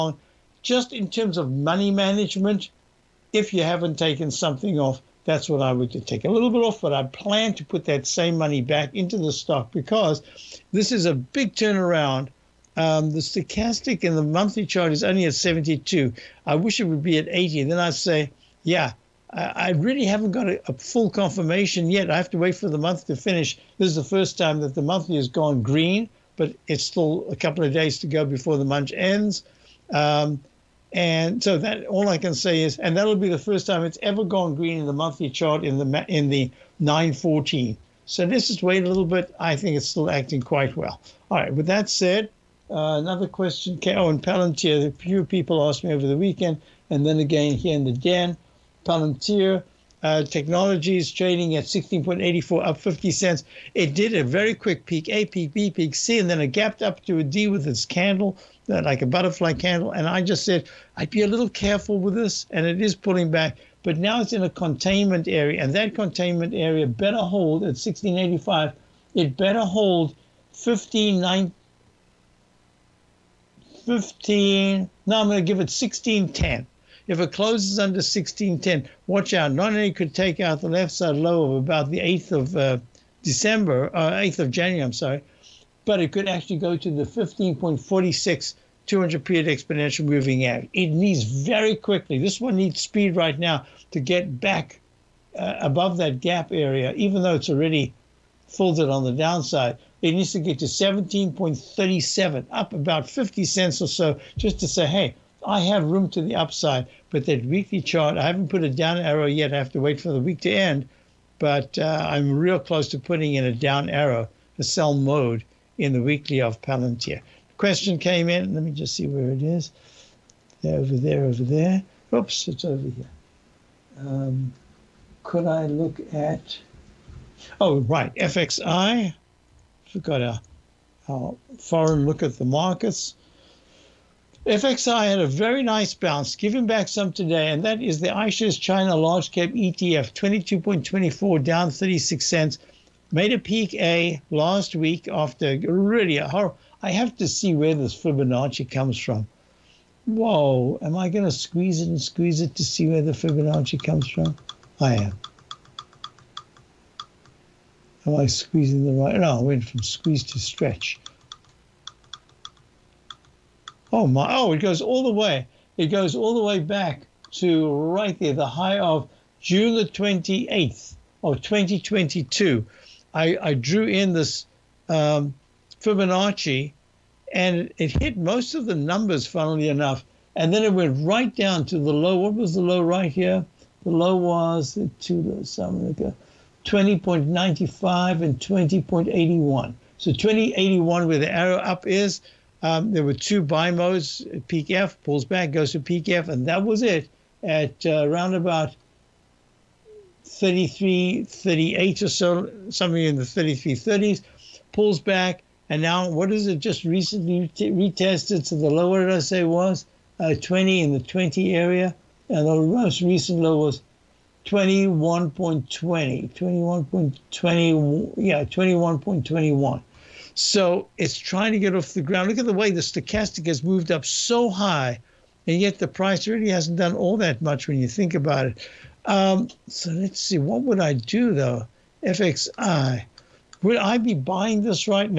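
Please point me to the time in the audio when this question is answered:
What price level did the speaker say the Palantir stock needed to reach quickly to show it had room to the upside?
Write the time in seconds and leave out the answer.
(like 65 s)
100 s.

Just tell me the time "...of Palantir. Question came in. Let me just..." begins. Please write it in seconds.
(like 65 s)
116 s.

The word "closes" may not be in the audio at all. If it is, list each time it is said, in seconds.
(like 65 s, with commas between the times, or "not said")
77 s, 112 s.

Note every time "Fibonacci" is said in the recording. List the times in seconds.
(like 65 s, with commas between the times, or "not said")
147 s, 153 s, 175 s.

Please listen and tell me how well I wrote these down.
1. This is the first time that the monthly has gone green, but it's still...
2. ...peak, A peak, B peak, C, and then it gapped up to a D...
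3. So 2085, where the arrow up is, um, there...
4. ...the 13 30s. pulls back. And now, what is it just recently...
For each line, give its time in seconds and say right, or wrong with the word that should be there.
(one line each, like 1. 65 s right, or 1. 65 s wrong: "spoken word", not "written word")
1. 23 s right
2. 54 s right
3. 189 s wrong: "2081", not "2085"
4. 203 s wrong: "33", not "13".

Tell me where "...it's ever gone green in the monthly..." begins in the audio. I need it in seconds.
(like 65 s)
33 s.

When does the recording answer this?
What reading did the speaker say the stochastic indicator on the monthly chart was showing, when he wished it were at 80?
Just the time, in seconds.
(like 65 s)
15 s.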